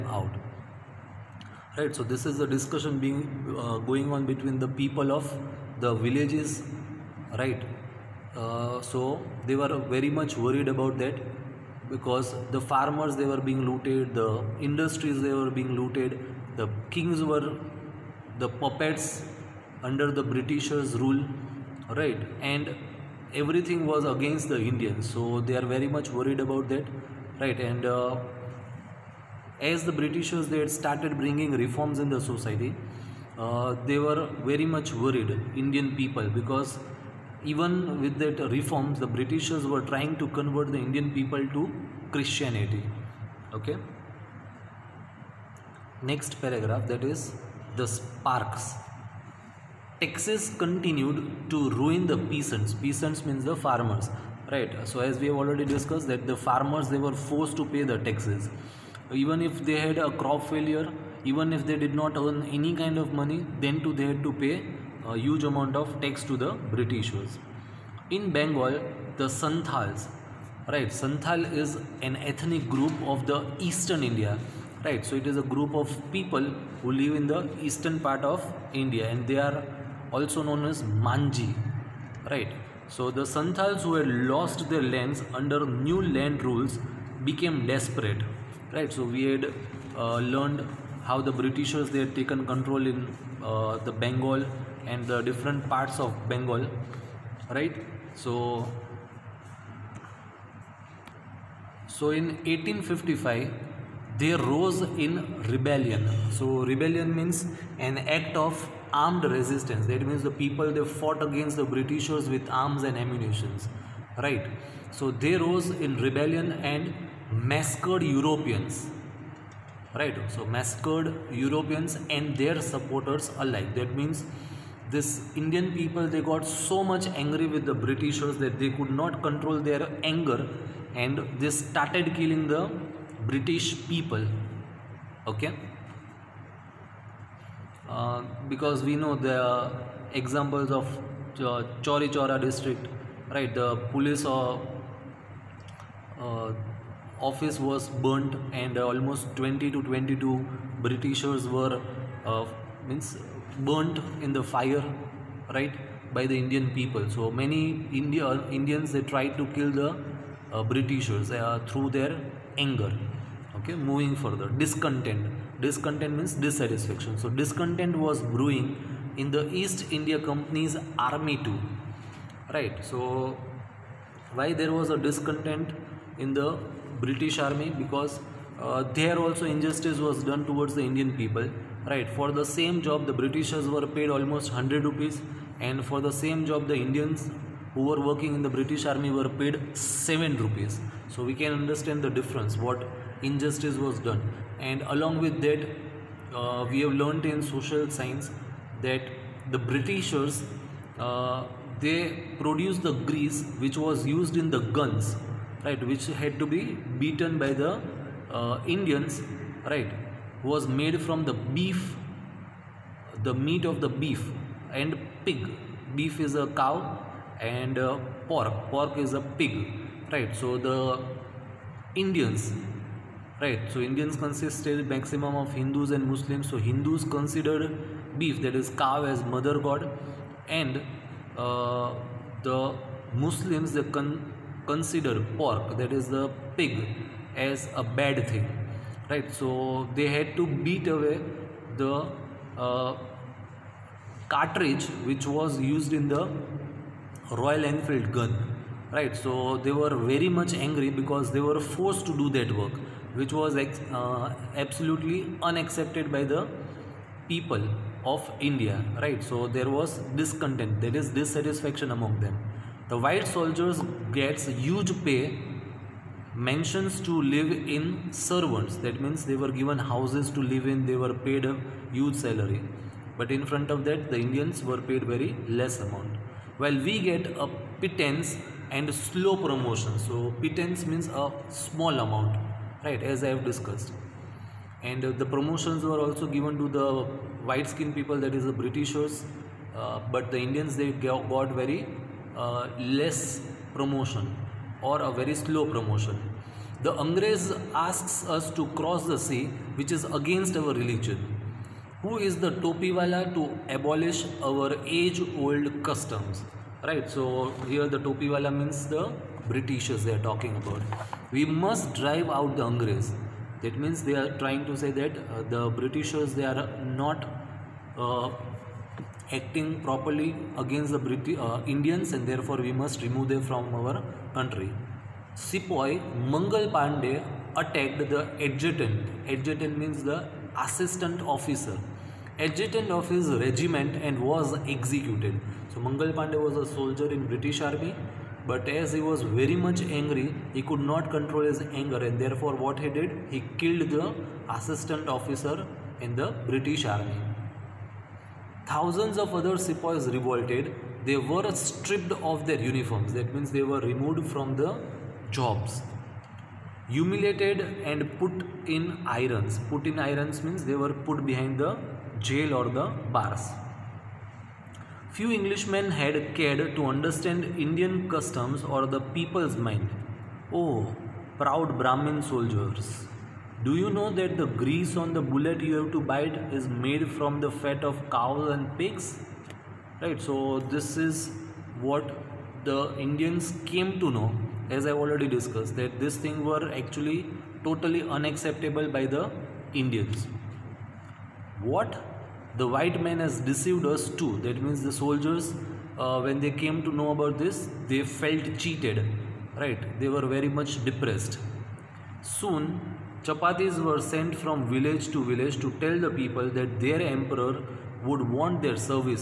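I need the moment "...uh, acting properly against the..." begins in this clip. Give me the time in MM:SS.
05:17.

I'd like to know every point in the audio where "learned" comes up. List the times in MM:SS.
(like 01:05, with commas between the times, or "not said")
01:30, 03:16.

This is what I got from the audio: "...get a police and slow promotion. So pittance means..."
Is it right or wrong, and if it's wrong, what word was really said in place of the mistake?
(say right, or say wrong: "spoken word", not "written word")
wrong: "pittance", not "police".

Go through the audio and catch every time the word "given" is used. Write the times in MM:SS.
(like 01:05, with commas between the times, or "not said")
04:29, 04:46.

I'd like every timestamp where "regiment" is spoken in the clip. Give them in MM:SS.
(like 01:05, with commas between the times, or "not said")
05:33.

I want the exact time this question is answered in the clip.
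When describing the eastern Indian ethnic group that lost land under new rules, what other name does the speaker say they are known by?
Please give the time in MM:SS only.
01:21.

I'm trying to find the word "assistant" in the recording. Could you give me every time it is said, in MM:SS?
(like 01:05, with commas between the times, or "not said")
05:30, 05:44.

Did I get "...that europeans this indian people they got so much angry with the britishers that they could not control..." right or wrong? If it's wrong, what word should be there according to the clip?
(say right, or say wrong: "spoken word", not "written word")
wrong: "means", not "europeans".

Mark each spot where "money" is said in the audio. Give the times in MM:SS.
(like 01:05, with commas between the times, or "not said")
01:03.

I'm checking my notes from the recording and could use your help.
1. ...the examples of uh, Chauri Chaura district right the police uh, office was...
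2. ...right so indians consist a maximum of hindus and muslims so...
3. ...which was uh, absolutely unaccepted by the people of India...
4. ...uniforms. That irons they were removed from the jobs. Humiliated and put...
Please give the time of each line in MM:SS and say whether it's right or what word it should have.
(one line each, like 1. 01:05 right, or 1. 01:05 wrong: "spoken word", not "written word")
1. 02:19 right
2. 03:43 right
3. 04:13 right
4. 05:52 wrong: "means", not "irons".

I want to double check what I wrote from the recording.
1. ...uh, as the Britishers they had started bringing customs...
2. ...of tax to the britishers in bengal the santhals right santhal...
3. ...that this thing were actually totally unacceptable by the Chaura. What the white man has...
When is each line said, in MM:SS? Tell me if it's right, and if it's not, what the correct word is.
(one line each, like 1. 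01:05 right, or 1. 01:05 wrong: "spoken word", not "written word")
1. 00:27 wrong: "reforms", not "customs"
2. 01:05 right
3. 06:25 wrong: "Indians", not "Chaura".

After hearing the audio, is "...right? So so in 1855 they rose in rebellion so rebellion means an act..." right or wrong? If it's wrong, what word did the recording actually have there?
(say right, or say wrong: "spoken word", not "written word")
right.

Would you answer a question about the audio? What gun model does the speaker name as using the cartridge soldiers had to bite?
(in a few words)
Royal Enfield.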